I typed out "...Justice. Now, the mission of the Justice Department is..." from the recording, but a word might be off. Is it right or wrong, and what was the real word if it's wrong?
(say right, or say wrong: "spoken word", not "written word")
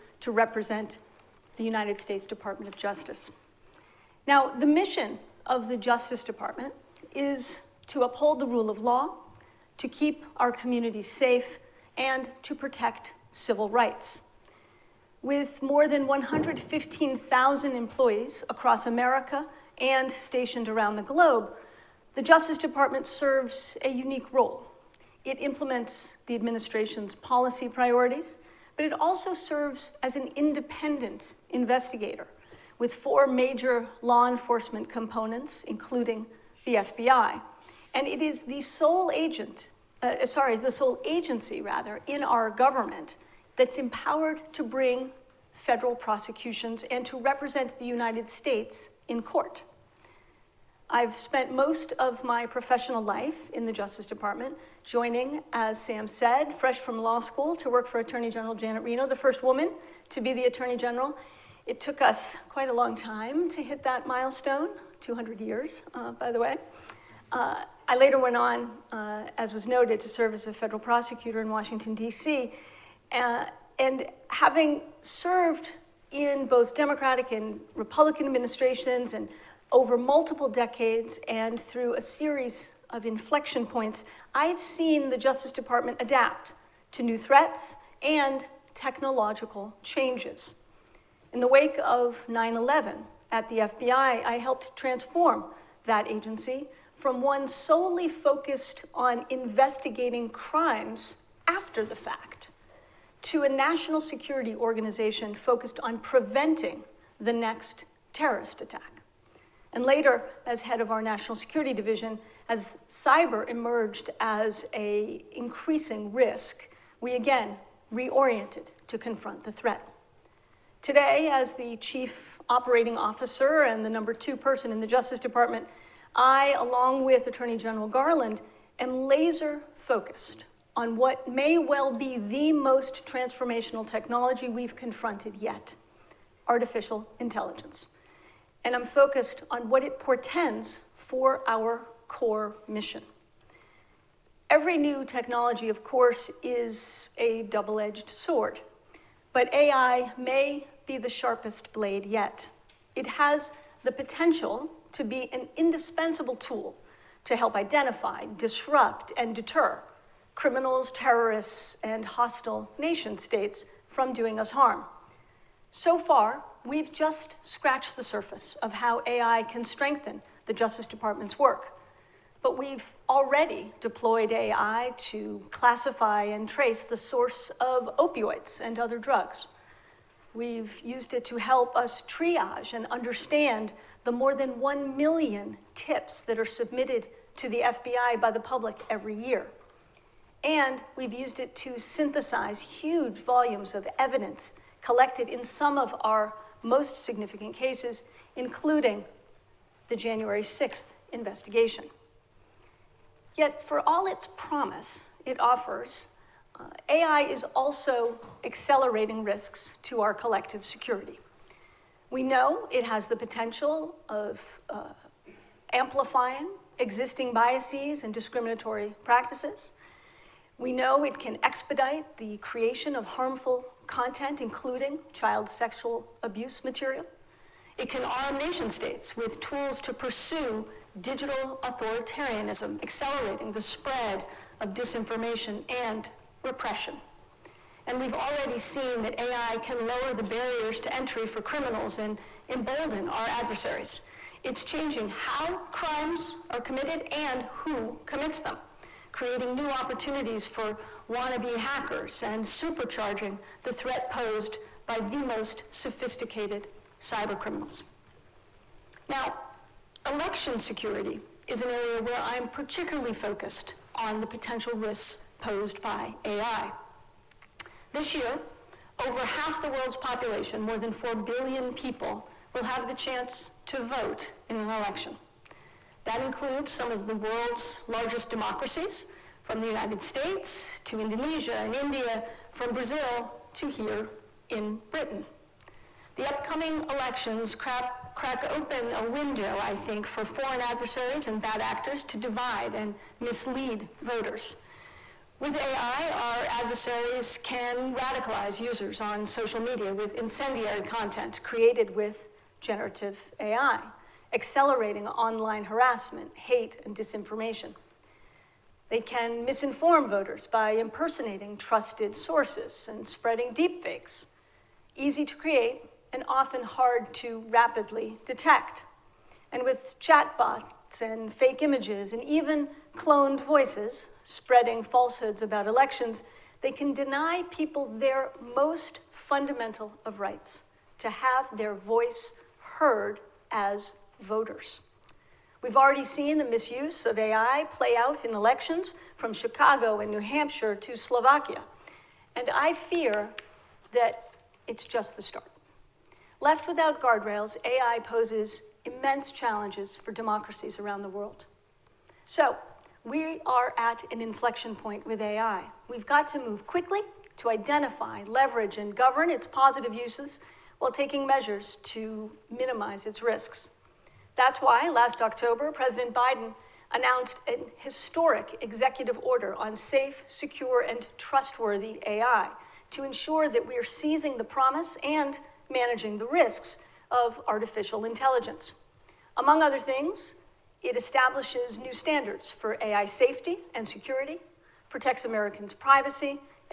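right.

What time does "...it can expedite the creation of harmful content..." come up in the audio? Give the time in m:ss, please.
3:41.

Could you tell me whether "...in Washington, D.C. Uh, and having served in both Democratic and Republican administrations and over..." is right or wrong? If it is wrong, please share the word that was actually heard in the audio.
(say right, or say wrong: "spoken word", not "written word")
right.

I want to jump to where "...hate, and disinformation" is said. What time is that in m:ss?
5:06.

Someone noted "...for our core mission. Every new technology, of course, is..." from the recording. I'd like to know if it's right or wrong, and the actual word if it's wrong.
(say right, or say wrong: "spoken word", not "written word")
right.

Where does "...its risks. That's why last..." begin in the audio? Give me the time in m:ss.
6:03.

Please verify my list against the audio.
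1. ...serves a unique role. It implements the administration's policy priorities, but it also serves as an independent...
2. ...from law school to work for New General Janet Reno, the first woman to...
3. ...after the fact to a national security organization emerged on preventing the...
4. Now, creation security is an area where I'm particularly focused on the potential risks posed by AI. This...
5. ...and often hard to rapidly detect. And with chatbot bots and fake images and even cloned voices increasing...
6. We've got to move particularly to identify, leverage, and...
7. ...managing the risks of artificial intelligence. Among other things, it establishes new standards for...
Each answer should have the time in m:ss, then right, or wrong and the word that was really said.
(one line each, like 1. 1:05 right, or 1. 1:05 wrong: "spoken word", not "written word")
1. 0:23 right
2. 0:56 wrong: "Attorney", not "New"
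3. 1:41 wrong: "focused", not "emerged"
4. 4:19 wrong: "election", not "creation"
5. 5:16 wrong: "spreading", not "increasing"
6. 5:55 wrong: "quickly", not "particularly"
7. 6:15 right.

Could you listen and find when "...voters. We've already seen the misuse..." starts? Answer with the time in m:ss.
5:34.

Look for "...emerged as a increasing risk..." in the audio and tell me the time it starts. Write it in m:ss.
1:53.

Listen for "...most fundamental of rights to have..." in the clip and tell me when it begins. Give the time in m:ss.
5:28.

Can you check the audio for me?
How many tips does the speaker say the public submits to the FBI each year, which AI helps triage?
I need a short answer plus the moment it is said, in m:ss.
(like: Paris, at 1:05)
1 million, at 3:04.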